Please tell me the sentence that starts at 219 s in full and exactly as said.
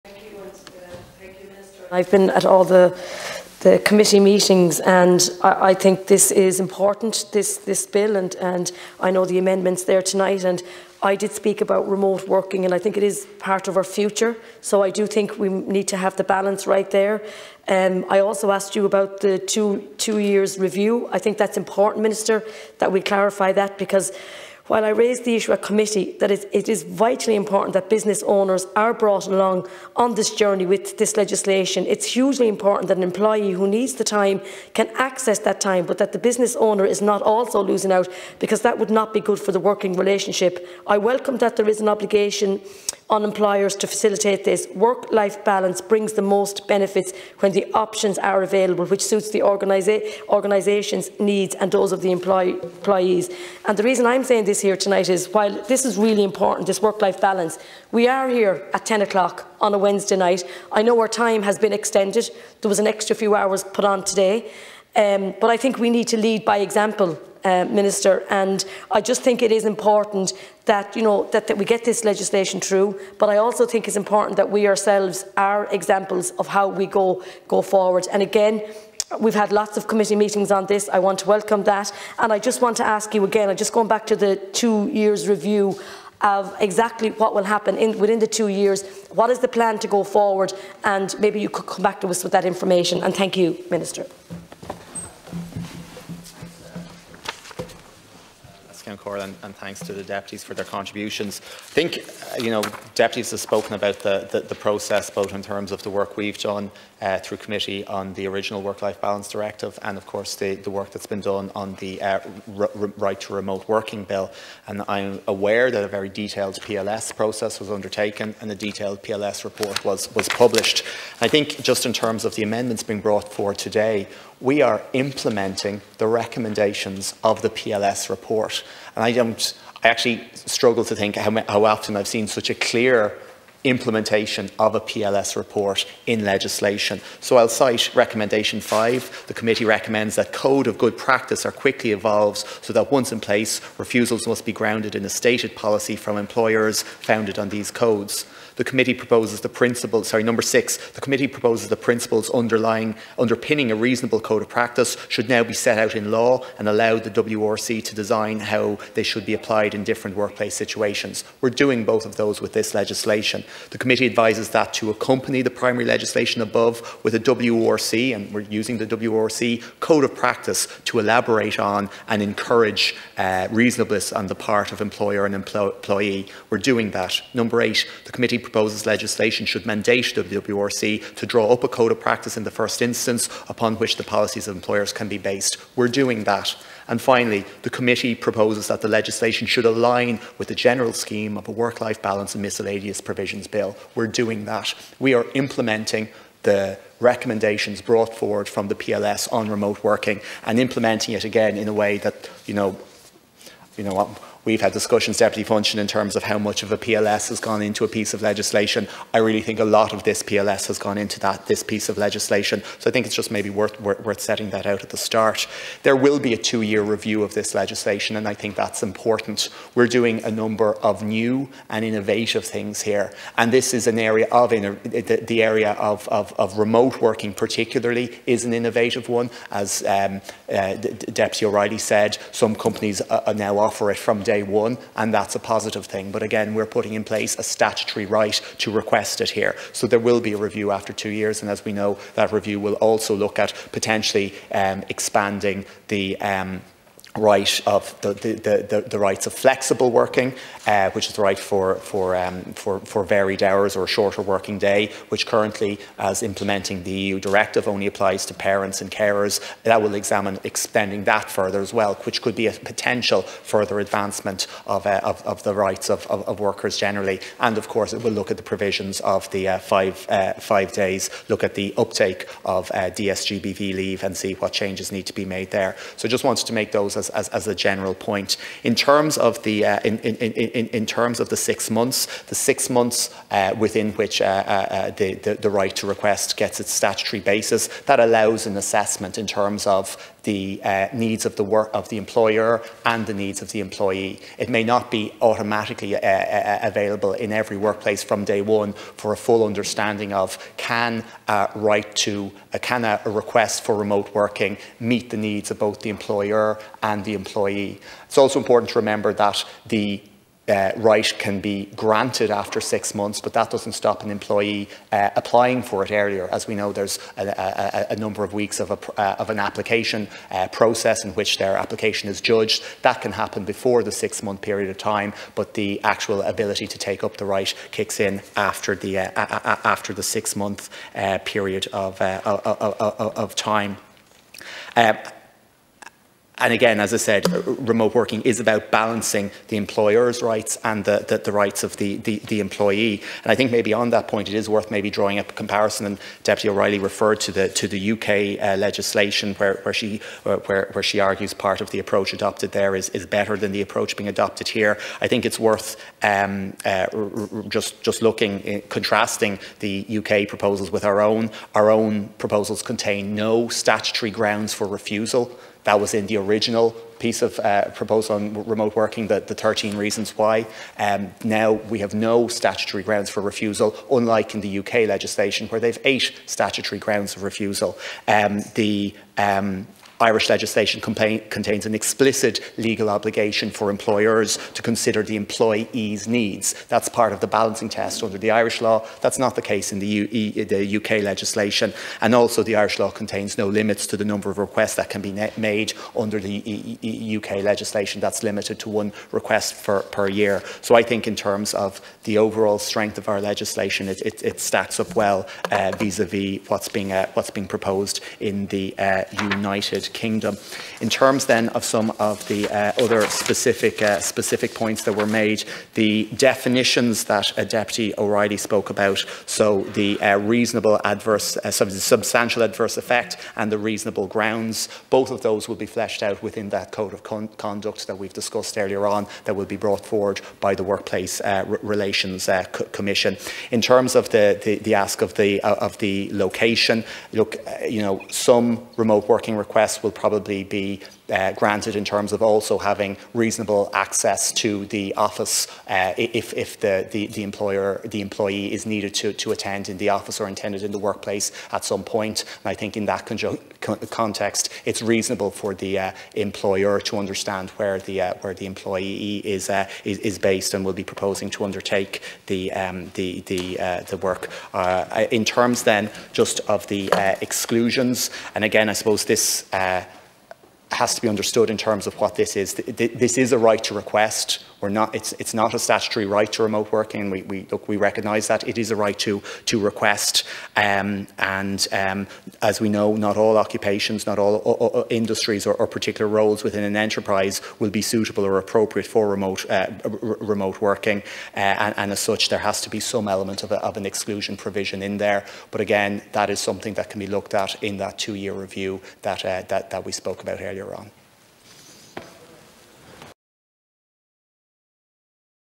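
We're doing a number of new and innovative things here.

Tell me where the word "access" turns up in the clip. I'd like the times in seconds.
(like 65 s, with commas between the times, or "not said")
34 s, 443 s.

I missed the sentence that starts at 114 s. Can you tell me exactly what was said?
And I'm aware that a very detailed PLS process was undertaken, and a detailed PLS report was, was published.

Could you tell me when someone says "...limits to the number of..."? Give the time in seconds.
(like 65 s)
393 s.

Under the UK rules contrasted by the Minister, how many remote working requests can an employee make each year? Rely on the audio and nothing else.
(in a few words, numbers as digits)
1.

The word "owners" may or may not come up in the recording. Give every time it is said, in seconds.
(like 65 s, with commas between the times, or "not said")
28 s, 36 s.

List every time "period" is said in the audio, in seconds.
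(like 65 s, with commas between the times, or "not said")
324 s, 331 s.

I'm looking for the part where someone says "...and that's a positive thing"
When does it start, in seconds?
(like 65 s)
235 s.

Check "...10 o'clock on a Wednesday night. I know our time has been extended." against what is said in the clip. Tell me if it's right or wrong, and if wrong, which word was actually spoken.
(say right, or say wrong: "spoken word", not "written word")
right.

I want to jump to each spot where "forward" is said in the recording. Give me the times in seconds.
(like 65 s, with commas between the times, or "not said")
77 s, 90 s, 123 s, 198 s, 429 s.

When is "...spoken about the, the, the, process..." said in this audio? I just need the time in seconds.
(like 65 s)
103 s.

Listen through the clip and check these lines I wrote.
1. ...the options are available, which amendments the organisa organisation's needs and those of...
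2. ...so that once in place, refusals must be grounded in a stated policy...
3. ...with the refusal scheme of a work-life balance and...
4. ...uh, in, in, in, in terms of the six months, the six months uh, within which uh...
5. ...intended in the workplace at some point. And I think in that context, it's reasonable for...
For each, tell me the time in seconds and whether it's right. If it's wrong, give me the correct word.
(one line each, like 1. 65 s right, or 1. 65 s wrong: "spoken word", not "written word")
1. 47 s wrong: "suits", not "amendments"
2. 142 s right
3. 190 s wrong: "general", not "refusal"
4. 279 s right
5. 450 s right.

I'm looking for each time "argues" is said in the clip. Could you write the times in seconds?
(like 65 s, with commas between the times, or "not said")
350 s.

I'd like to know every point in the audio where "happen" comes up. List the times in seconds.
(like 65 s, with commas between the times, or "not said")
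87 s, 323 s.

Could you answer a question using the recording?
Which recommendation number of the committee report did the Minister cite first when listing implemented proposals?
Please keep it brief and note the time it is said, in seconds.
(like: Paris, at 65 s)
5, at 137 s.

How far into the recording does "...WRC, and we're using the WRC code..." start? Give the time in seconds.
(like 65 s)
167 s.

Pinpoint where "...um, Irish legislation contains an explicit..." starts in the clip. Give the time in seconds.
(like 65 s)
379 s.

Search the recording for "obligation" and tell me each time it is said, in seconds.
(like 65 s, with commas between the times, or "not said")
41 s, 382 s.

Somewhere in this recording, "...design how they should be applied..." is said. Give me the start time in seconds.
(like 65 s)
157 s.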